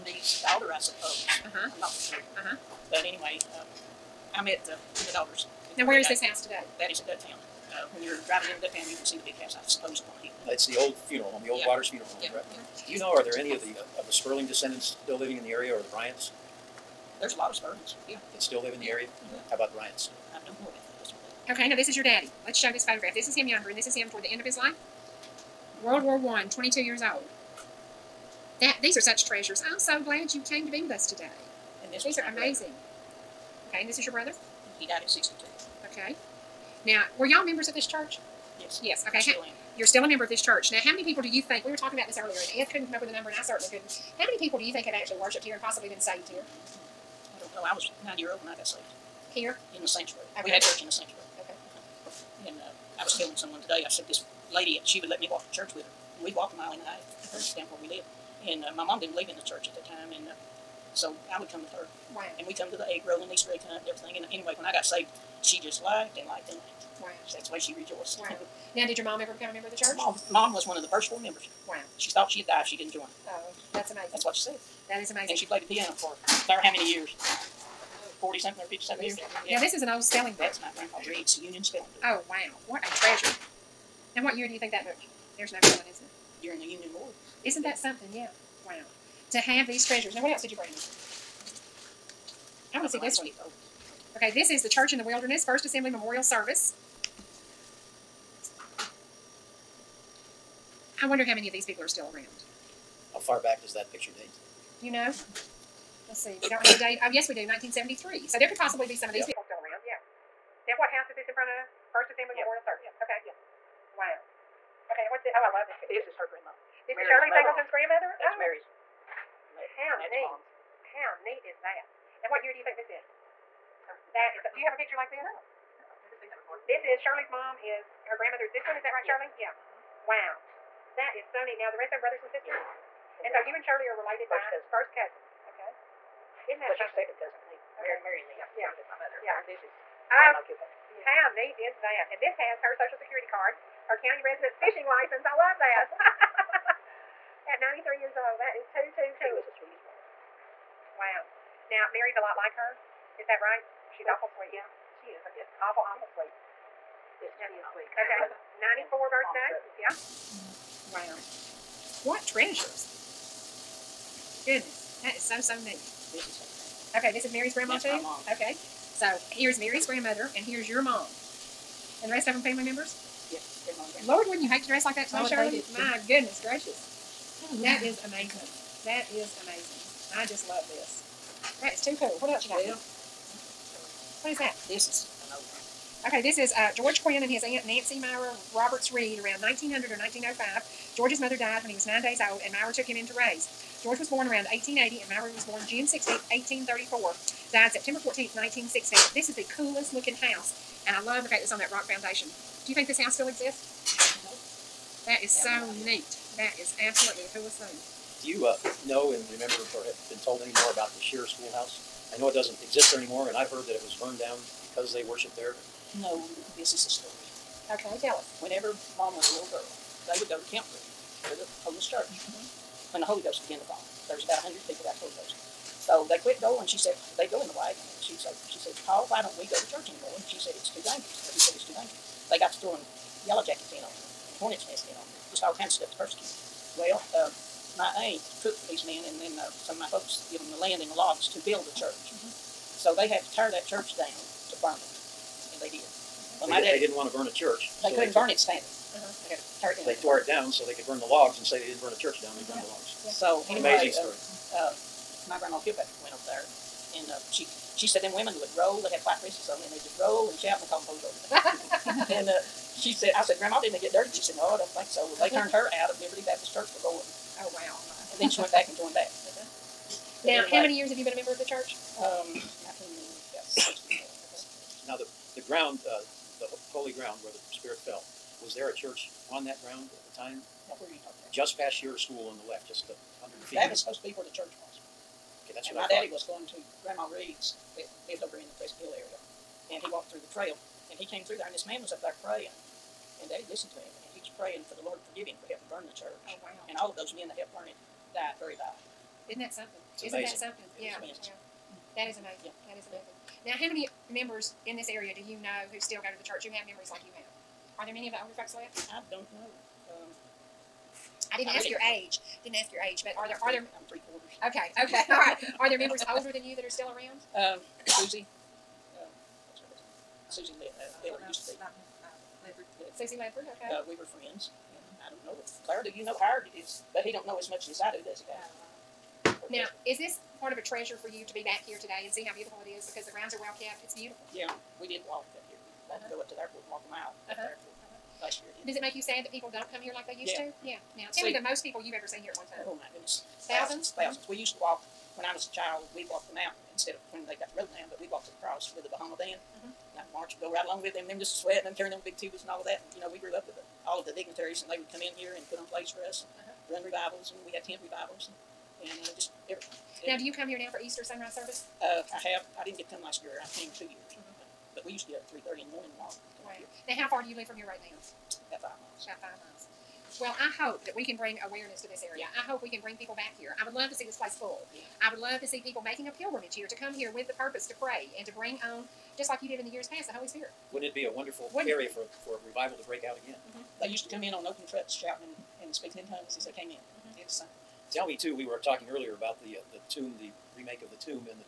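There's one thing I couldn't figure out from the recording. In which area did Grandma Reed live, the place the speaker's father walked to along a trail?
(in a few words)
Pleasant Hill.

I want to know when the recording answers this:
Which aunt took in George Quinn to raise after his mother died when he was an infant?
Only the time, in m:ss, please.
3:07.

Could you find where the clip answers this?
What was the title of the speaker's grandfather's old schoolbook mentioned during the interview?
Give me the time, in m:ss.
1:21.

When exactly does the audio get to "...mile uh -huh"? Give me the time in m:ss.
5:36.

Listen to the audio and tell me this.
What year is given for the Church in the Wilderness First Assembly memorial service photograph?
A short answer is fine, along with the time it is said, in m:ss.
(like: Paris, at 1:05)
1973, at 1:47.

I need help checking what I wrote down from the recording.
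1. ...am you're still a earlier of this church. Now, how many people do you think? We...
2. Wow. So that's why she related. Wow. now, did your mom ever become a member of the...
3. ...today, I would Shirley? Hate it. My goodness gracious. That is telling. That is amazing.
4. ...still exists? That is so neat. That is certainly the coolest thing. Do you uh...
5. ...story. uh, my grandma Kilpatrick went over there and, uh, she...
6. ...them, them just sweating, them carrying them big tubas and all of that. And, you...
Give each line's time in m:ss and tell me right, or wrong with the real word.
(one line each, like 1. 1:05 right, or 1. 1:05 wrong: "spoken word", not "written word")
1. 0:39 wrong: "member", not "earlier"
2. 1:07 wrong: "rejoiced", not "related"
3. 2:55 wrong: "amazing", not "telling"
4. 3:23 wrong: "absolutely", not "certainly"
5. 4:14 right
6. 5:50 right.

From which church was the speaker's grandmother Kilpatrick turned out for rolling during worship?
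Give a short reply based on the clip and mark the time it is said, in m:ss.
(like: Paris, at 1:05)
Liberty Baptist Church, at 4:25.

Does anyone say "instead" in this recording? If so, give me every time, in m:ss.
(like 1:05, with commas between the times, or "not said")
5:46.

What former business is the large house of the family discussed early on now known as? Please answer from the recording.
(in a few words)
Waters Funeral Home.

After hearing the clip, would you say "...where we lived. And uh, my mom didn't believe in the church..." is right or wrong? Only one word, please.
right.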